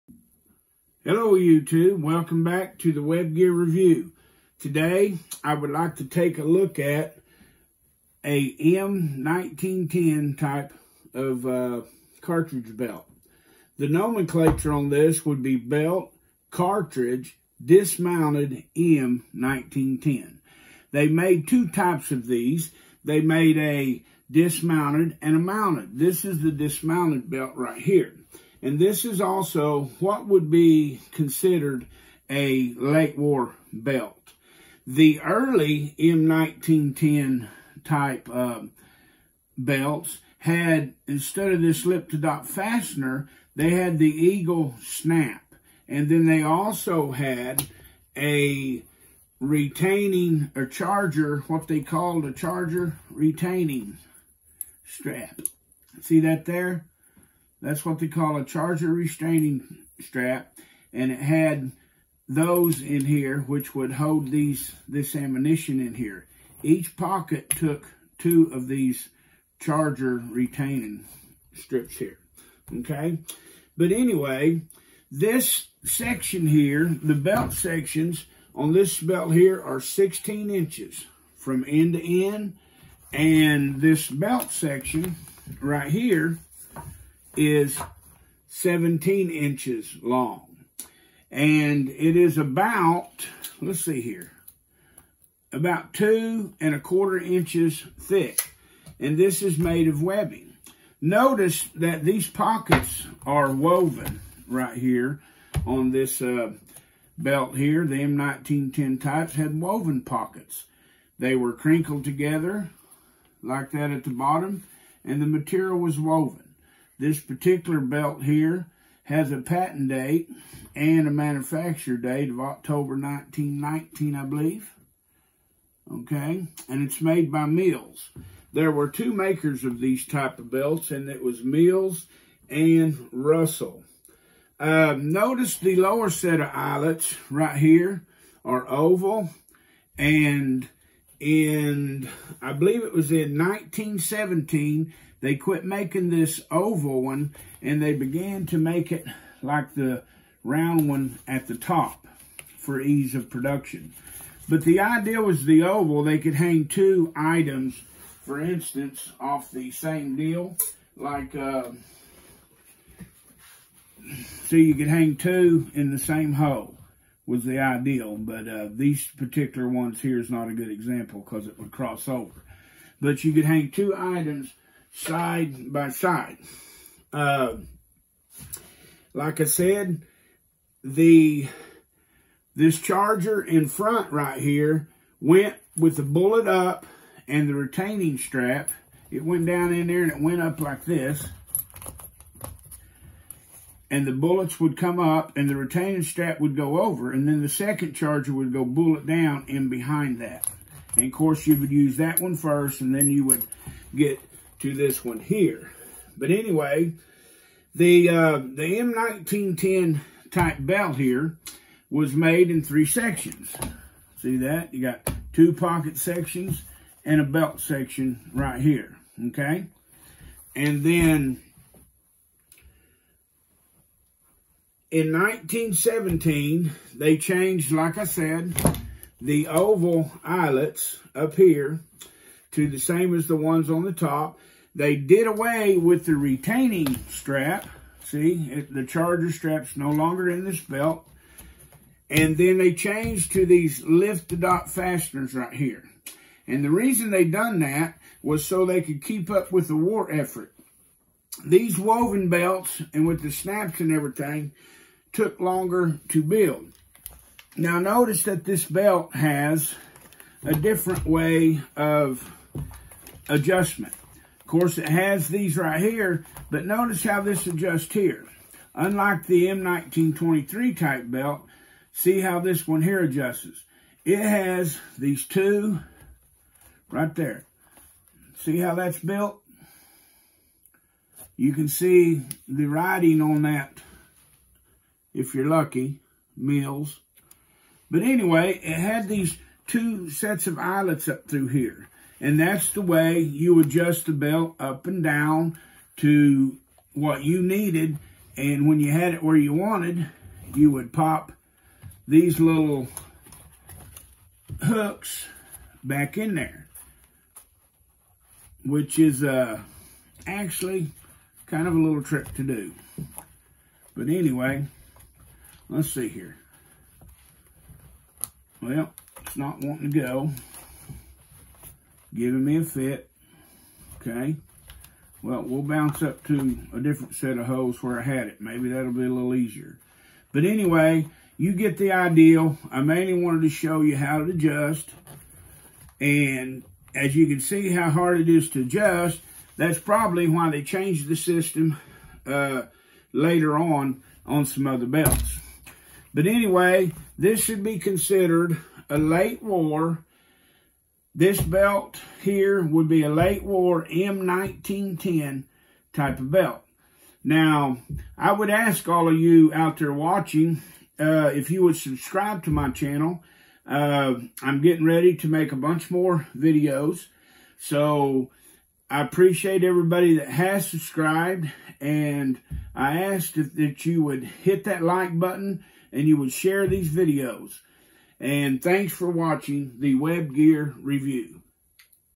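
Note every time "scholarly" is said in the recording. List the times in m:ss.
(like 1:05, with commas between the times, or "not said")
not said.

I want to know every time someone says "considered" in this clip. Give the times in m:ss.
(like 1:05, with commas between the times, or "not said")
0:31, 5:47.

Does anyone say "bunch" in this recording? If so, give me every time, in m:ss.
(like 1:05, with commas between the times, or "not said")
6:05.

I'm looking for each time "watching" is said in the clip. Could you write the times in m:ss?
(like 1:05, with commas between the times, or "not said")
5:59, 6:19.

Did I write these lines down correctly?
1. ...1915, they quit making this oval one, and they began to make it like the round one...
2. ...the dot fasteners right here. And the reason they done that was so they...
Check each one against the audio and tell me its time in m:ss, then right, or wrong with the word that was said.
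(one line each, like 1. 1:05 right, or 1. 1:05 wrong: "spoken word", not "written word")
1. 2:23 wrong: "1917", not "1915"
2. 4:04 right.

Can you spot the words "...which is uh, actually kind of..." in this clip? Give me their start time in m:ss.
5:08.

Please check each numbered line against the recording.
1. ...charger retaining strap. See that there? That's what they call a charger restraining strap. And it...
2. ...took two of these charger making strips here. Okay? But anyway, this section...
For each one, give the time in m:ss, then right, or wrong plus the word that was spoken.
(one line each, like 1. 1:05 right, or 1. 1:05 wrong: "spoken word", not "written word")
1. 0:52 right
2. 1:07 wrong: "retaining", not "making".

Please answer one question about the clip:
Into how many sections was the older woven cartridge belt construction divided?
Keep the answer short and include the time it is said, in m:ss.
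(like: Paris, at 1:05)
three, at 3:32.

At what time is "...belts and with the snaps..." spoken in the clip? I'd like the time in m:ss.
4:12.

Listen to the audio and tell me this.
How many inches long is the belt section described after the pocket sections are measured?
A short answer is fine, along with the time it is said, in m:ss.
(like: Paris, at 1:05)
17 inches, at 1:28.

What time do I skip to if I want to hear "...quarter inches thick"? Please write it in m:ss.
1:36.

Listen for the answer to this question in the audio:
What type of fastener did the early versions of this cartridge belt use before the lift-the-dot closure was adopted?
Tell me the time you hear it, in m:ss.
0:44.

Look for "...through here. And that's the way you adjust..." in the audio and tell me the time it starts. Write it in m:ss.
4:51.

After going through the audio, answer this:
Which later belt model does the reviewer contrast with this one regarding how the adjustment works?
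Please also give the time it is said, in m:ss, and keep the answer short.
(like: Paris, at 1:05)
M1923, at 4:29.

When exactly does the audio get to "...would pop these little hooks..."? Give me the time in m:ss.
5:00.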